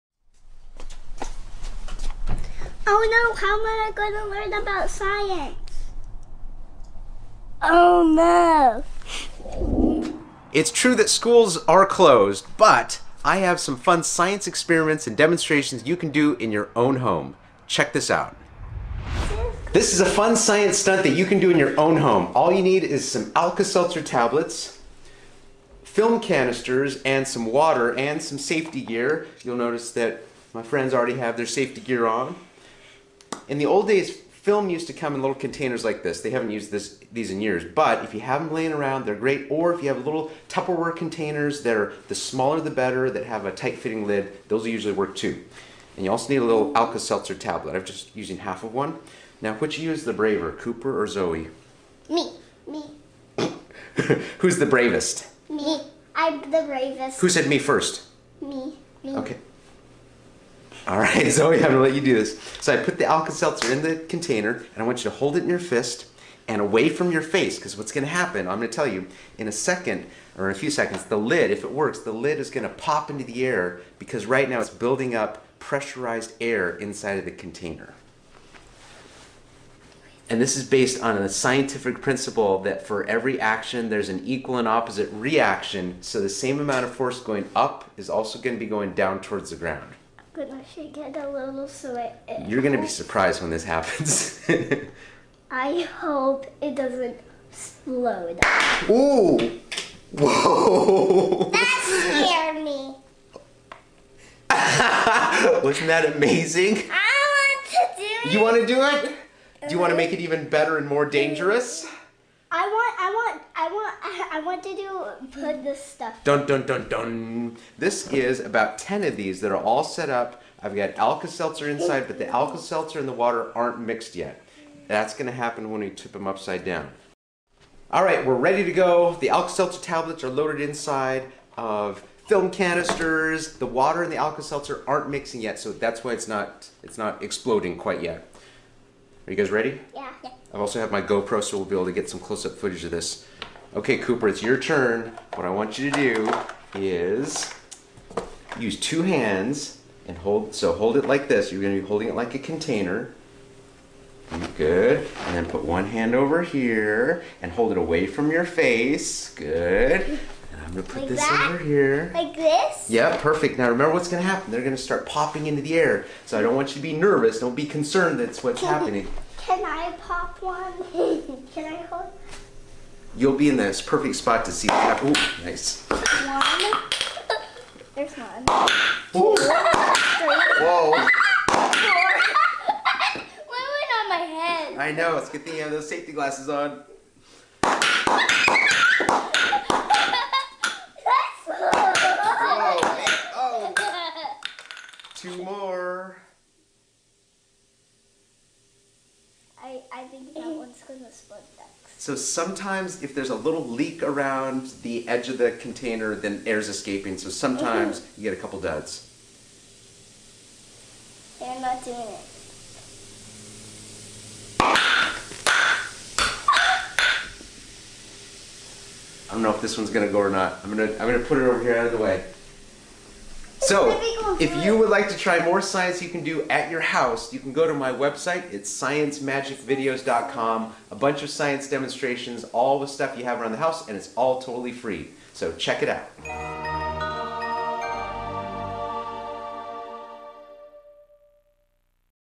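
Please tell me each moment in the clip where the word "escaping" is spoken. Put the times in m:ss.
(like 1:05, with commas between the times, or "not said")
3:26.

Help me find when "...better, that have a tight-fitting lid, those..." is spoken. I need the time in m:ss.
0:42.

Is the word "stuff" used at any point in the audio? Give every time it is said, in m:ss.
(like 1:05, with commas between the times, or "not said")
1:55, 3:52.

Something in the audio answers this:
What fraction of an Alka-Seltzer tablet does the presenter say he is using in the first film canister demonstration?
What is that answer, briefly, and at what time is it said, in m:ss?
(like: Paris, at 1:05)
half, at 0:48.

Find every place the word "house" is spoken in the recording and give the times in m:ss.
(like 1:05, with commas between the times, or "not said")
3:46, 3:53.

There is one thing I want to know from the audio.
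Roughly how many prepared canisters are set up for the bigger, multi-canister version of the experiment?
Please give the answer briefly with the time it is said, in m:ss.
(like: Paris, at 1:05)
10, at 1:58.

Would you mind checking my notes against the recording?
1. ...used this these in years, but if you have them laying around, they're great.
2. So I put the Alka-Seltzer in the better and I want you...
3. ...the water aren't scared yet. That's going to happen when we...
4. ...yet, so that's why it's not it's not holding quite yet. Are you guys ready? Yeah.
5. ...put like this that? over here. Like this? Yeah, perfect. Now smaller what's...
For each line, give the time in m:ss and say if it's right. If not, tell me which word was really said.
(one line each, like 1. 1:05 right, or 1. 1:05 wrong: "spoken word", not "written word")
1. 0:36 right
2. 1:02 wrong: "container", not "better"
3. 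2:03 wrong: "mixed", not "scared"
4. 2:15 wrong: "exploding", not "holding"
5. 2:40 wrong: "remember", not "smaller".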